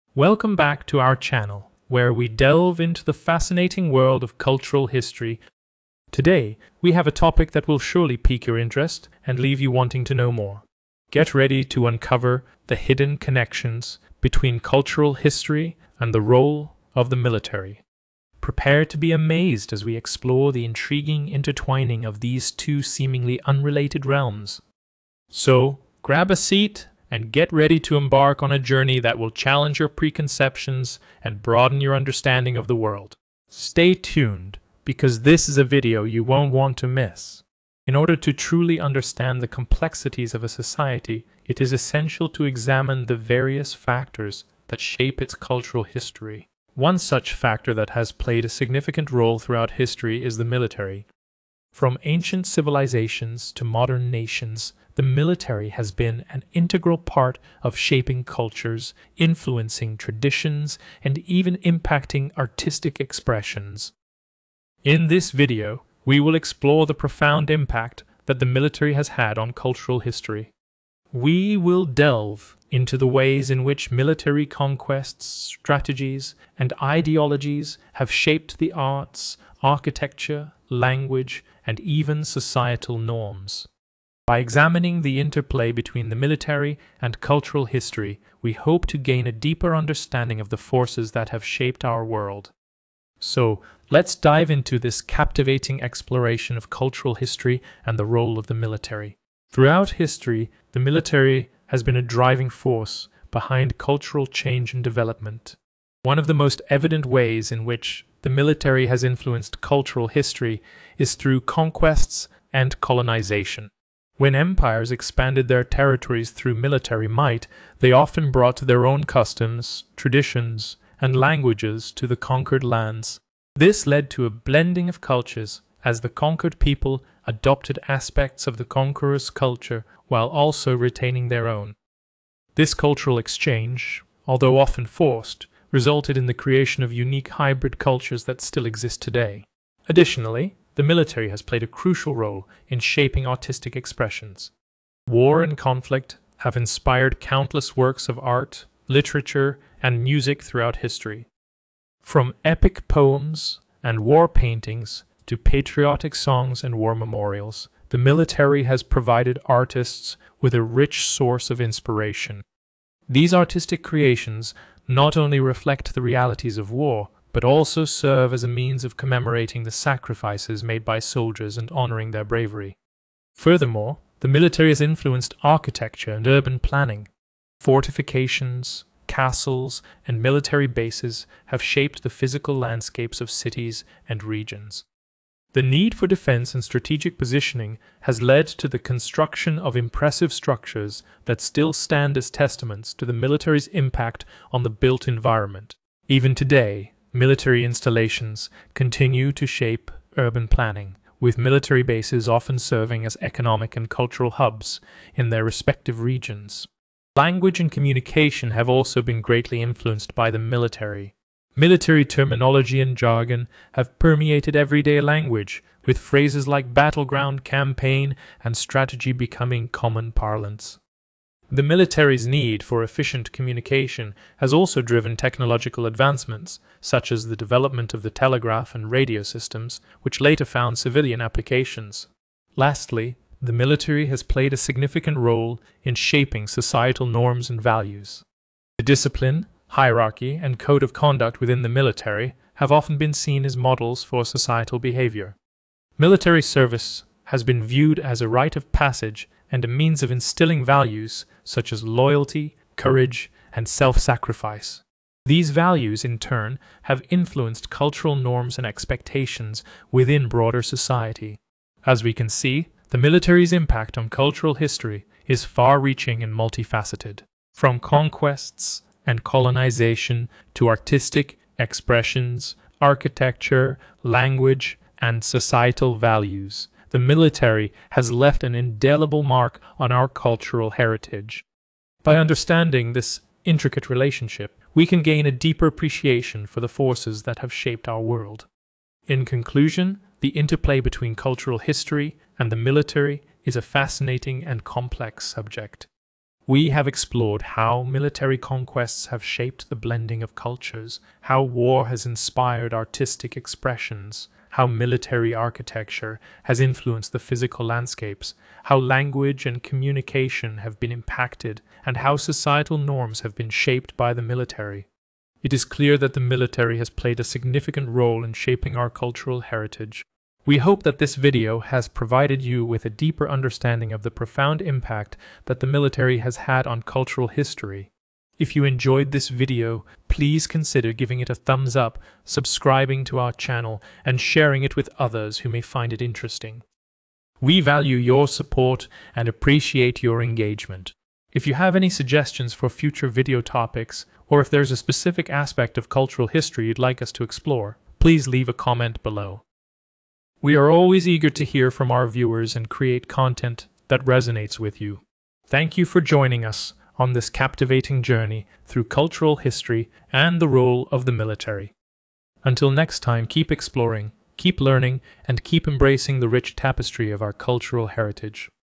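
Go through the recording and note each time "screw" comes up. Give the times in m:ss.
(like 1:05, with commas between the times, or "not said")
not said.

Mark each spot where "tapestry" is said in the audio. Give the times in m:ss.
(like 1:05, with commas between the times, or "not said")
6:06.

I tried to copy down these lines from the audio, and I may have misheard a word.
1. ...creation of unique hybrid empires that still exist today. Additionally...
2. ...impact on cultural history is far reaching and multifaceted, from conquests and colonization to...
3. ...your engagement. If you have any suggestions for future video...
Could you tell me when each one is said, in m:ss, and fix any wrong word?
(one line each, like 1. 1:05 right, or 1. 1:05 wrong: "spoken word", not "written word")
1. 2:16 wrong: "cultures", not "empires"
2. 4:23 right
3. 5:40 right.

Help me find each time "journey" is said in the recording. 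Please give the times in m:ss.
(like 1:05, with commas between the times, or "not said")
0:28, 5:58.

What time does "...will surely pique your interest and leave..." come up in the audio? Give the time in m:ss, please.
0:07.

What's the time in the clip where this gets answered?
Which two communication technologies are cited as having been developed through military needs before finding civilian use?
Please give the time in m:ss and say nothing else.
3:48.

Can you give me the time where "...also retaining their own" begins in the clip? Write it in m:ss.
2:10.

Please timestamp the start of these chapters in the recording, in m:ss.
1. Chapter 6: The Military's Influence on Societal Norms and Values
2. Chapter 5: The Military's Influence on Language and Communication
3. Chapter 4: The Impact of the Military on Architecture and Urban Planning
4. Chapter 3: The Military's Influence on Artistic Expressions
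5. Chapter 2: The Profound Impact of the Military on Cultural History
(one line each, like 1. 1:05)
1. 3:50
2. 3:25
3. 2:55
4. 2:23
5. 1:04.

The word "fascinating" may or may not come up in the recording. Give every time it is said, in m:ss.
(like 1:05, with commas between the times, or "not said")
0:03, 4:53.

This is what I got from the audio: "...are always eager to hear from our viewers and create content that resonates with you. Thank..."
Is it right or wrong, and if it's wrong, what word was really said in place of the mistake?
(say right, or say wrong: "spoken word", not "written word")
right.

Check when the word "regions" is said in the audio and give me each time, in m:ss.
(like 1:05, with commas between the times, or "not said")
3:04, 3:25.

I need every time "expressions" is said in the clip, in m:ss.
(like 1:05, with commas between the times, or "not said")
1:02, 2:23, 4:31, 5:03.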